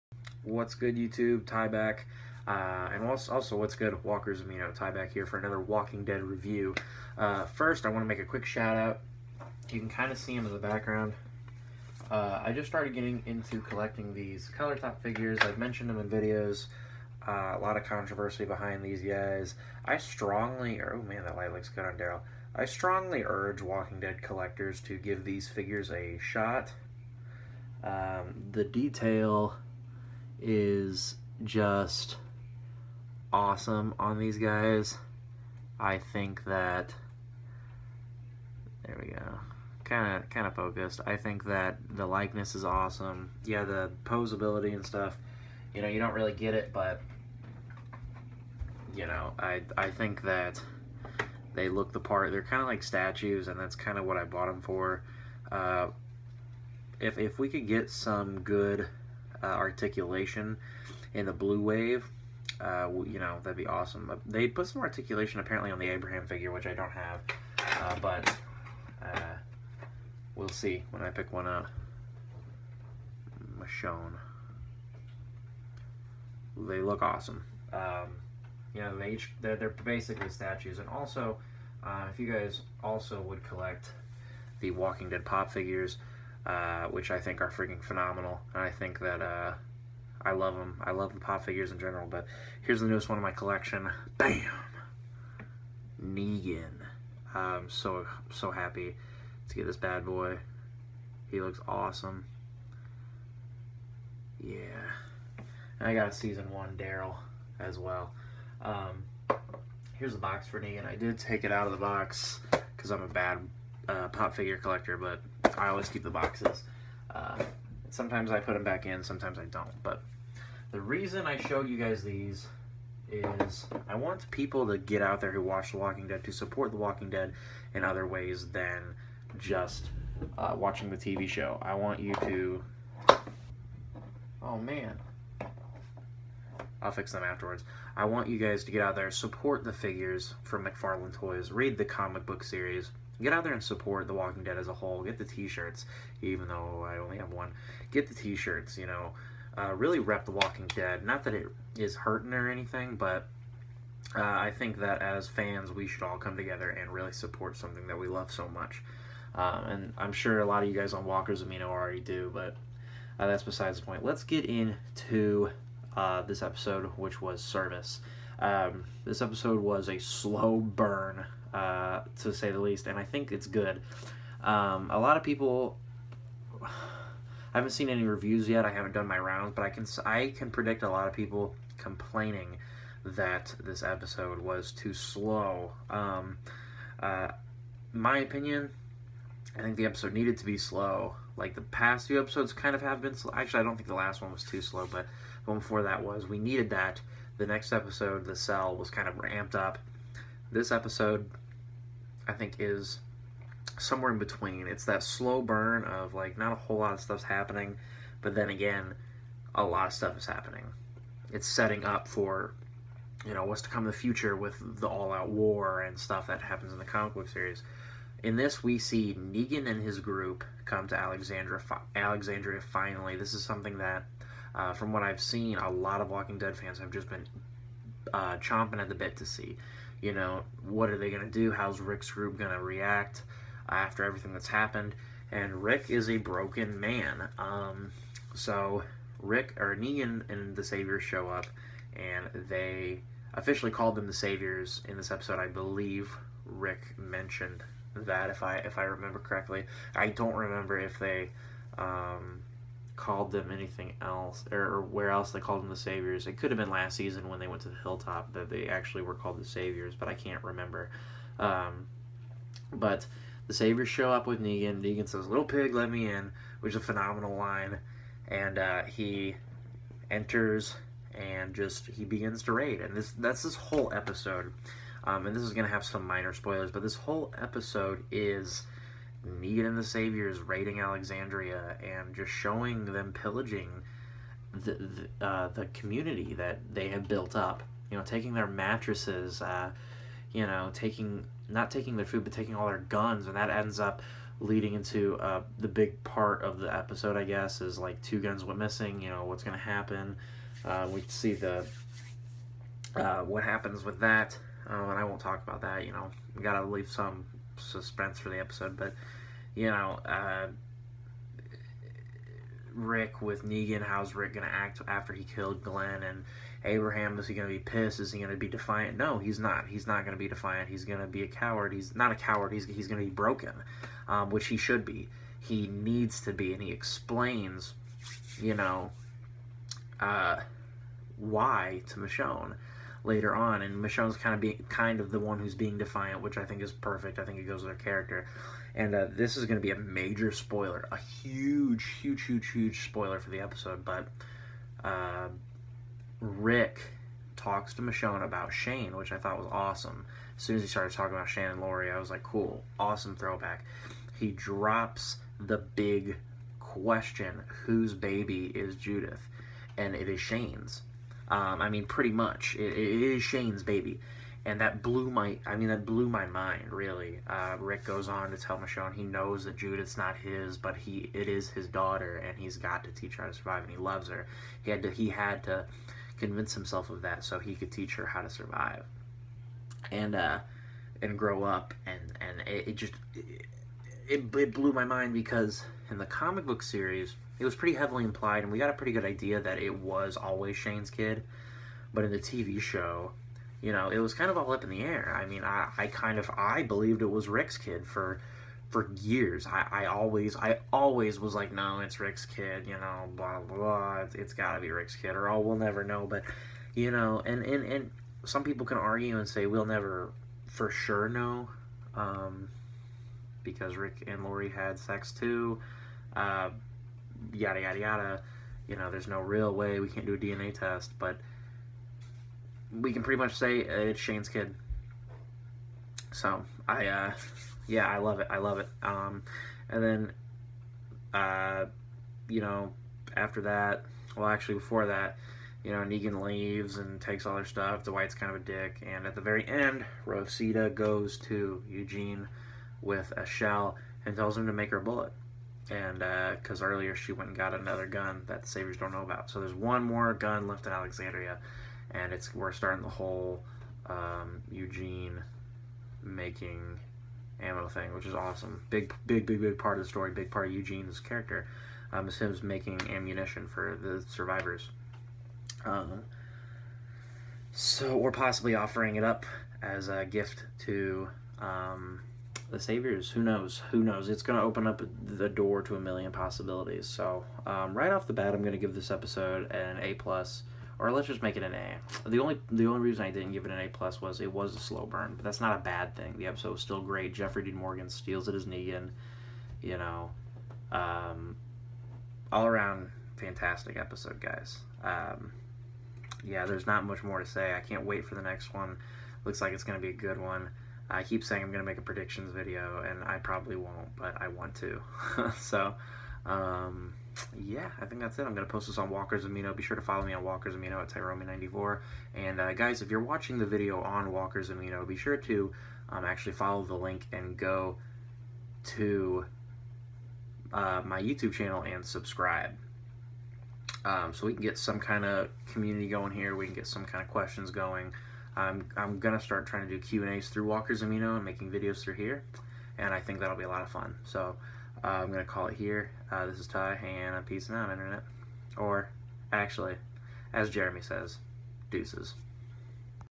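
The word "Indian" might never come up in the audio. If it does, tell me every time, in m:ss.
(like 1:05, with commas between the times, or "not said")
not said.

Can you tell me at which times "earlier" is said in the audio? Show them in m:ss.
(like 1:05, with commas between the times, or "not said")
7:26.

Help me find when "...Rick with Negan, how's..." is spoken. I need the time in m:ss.
5:12.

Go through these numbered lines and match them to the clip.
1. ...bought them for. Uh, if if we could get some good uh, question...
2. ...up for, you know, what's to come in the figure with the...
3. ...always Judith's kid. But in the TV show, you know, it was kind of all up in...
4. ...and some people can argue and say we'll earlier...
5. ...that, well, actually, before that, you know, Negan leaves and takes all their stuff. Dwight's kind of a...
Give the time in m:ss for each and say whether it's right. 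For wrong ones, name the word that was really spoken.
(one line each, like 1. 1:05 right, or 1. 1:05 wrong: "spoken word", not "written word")
1. 0:54 wrong: "articulation", not "question"
2. 3:31 wrong: "future", not "figure"
3. 6:30 wrong: "Shane", not "Judith"
4. 6:47 wrong: "never", not "earlier"
5. 7:13 right.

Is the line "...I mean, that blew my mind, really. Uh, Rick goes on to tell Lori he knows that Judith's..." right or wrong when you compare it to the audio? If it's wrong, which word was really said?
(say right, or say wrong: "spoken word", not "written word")
wrong: "Michonne", not "Lori".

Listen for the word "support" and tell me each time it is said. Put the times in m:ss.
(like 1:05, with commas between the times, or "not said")
2:06, 2:19, 2:23, 2:37.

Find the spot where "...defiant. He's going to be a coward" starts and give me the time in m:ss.
5:20.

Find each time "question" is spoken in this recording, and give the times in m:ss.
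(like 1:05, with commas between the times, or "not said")
5:56, 8:47.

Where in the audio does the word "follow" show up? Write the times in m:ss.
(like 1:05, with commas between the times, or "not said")
8:29, 8:36.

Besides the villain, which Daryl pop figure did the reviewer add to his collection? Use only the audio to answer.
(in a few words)
Season one Daryl.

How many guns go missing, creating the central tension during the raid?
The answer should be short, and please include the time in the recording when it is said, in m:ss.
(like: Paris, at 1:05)
2, at 4:58.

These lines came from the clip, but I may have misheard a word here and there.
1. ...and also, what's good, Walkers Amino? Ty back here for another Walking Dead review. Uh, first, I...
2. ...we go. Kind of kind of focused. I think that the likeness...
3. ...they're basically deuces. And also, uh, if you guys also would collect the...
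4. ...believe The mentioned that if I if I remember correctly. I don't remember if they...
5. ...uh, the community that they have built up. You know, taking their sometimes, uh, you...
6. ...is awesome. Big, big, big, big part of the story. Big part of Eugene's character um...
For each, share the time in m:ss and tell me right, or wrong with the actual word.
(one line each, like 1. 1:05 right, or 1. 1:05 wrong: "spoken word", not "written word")
1. 0:02 right
2. 0:39 right
3. 1:19 wrong: "statues", not "deuces"
4. 4:05 wrong: "Rick", not "The"
5. 4:45 wrong: "mattresses", not "sometimes"
6. 7:38 right.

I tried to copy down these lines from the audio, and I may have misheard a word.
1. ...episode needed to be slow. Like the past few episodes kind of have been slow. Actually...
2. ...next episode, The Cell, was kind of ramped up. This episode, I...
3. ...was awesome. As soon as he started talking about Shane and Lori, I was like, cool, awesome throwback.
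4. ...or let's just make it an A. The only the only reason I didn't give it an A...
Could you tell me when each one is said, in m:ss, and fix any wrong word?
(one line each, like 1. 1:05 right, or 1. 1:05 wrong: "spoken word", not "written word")
1. 3:09 right
2. 3:17 right
3. 5:49 right
4. 8:00 right.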